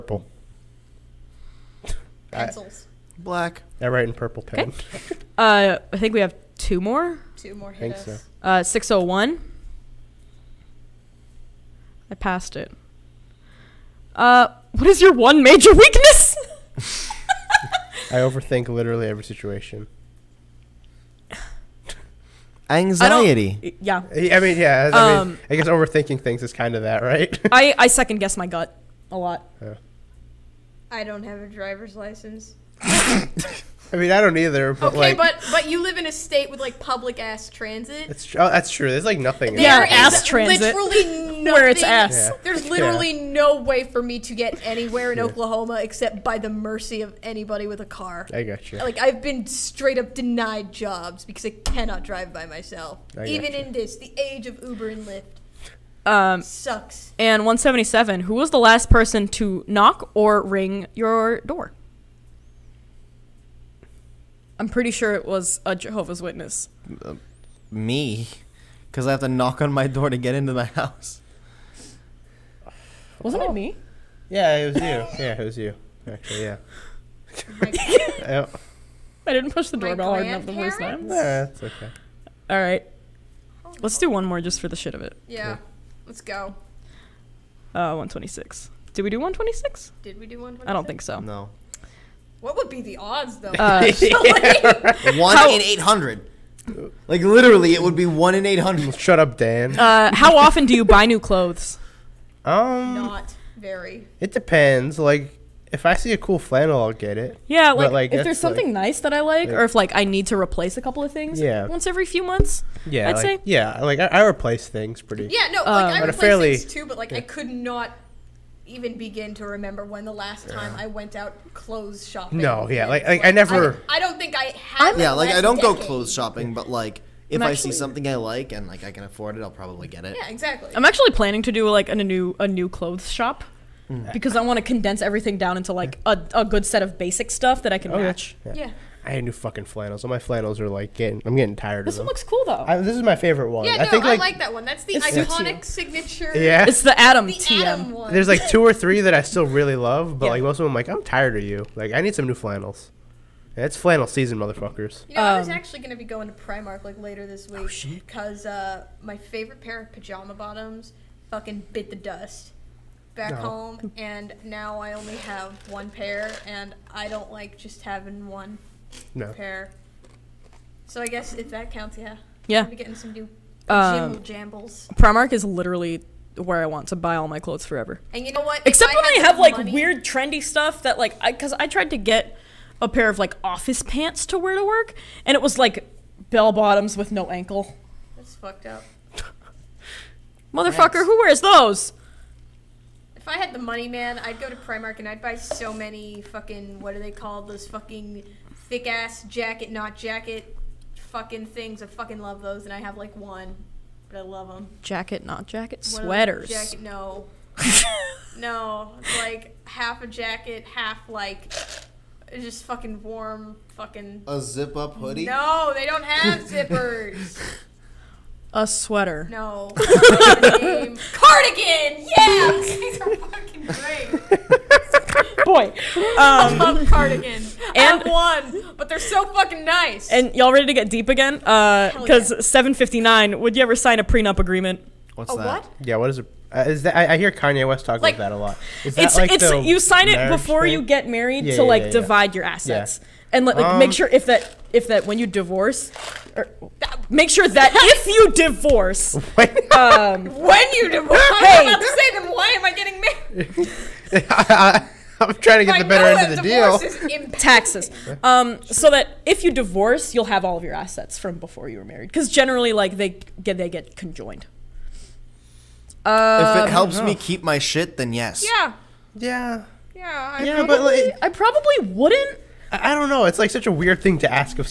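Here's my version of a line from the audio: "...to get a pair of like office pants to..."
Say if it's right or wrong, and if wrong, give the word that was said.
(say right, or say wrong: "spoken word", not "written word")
right.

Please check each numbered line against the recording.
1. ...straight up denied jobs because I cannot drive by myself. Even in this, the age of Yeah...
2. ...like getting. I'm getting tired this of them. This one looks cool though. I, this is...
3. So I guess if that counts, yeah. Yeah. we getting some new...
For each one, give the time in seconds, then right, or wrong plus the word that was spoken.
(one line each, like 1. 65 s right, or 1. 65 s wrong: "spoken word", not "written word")
1. 49 s wrong: "Uber", not "Yeah"
2. 140 s right
3. 170 s right.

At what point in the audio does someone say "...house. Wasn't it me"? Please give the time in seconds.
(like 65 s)
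70 s.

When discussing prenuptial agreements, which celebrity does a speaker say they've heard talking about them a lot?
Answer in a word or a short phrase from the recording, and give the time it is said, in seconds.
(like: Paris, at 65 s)
Kanye West, at 237 s.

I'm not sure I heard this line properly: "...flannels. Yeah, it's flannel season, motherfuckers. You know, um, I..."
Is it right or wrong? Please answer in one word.
right.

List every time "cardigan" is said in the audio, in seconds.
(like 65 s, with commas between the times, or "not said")
219 s, 226 s.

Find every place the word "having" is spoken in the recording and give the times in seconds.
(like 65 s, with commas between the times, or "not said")
167 s.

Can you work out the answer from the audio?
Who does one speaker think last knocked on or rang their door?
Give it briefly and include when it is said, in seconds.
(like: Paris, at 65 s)
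A Jehovah's Witness, at 65 s.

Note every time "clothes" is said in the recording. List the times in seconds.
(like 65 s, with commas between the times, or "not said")
101 s, 121 s, 125 s, 132 s, 177 s.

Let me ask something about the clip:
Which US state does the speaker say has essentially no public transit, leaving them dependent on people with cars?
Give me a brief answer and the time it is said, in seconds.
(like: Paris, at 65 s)
Oklahoma, at 45 s.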